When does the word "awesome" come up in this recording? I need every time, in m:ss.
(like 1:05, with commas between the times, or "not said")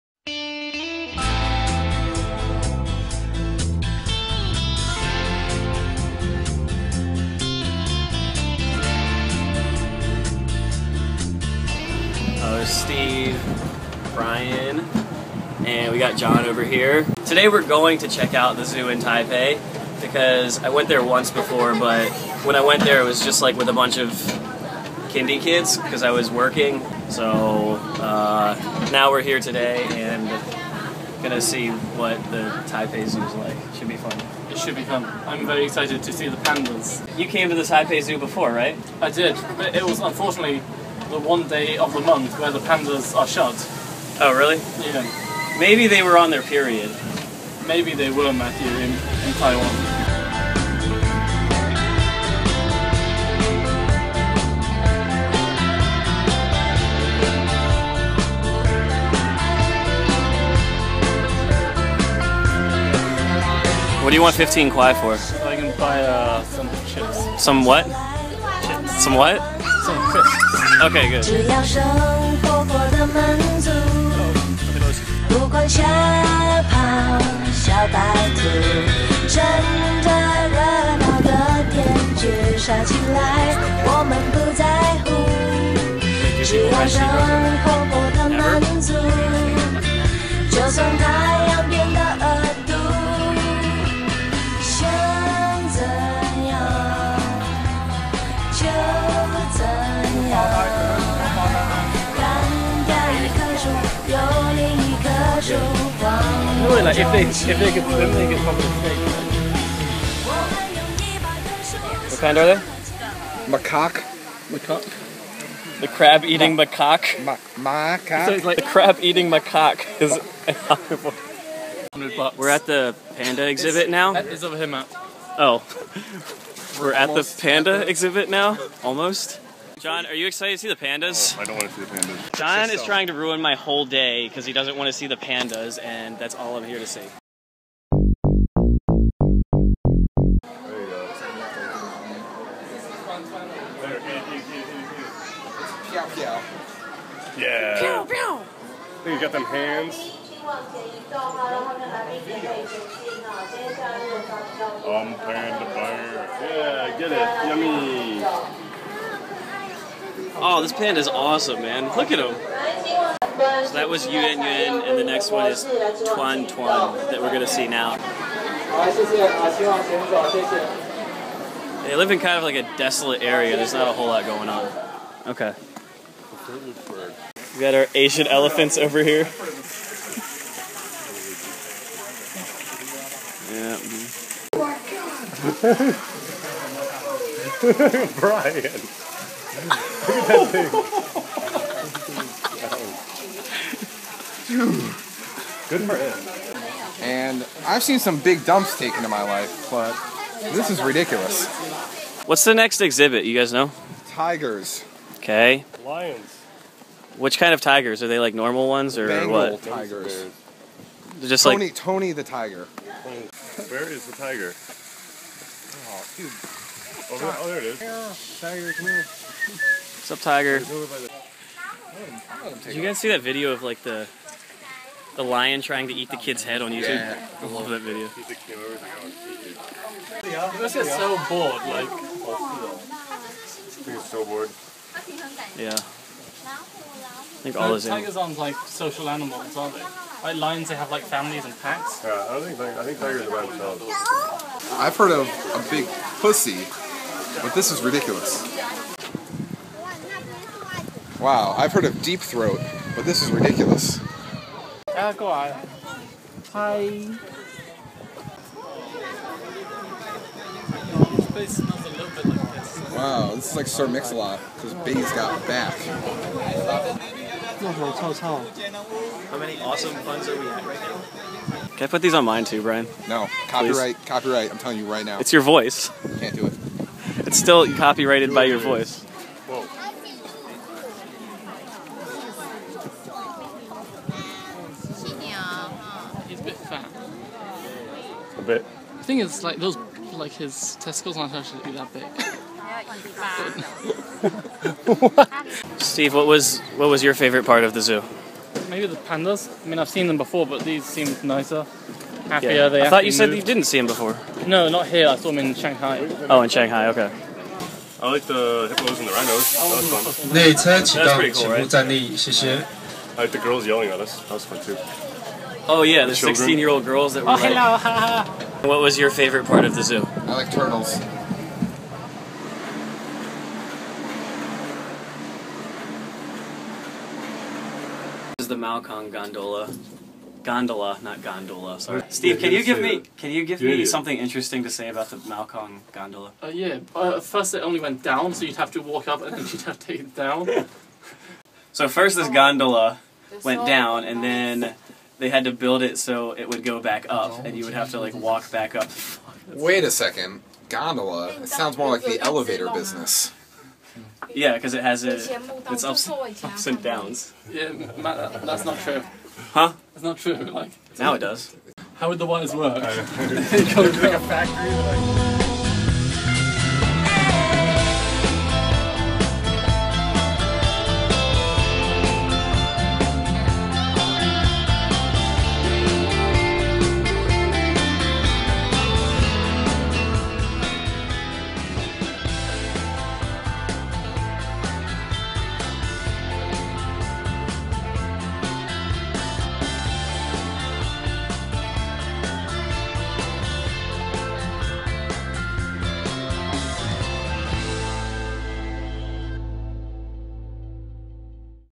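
2:41, 4:29.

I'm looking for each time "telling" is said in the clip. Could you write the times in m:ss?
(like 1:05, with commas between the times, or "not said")
4:34.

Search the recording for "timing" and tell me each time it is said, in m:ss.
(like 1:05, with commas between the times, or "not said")
not said.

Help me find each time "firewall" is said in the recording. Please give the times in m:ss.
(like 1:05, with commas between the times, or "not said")
not said.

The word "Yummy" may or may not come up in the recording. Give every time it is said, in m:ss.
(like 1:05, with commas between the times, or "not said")
2:38.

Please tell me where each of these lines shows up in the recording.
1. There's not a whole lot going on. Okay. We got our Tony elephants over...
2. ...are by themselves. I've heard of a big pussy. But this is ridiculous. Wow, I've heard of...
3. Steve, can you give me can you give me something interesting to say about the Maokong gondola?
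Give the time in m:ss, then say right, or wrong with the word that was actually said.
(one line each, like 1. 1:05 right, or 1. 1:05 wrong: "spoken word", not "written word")
1. 2:53 wrong: "Asian", not "Tony"
2. 4:03 right
3. 5:32 right.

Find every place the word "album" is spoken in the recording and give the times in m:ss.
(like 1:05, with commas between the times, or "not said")
not said.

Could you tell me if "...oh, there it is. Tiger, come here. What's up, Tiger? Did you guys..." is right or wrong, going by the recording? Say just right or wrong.
right.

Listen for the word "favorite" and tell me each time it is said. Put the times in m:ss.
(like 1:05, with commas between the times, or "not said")
4:57, 5:19.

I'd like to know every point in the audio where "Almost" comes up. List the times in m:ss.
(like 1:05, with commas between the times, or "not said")
2:08.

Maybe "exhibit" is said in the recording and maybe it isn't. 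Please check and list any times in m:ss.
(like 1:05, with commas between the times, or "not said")
2:03, 2:07, 3:22.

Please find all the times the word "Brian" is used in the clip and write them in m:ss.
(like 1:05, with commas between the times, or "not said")
0:14, 3:08, 4:32.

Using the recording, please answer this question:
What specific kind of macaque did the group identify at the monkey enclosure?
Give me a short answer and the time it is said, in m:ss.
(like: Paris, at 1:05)
Crab eating macaque, at 1:55.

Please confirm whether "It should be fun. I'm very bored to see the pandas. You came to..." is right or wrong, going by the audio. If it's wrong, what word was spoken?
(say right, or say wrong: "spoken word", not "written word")
wrong: "excited", not "bored".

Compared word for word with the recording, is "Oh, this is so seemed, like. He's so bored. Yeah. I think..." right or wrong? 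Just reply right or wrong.
wrong.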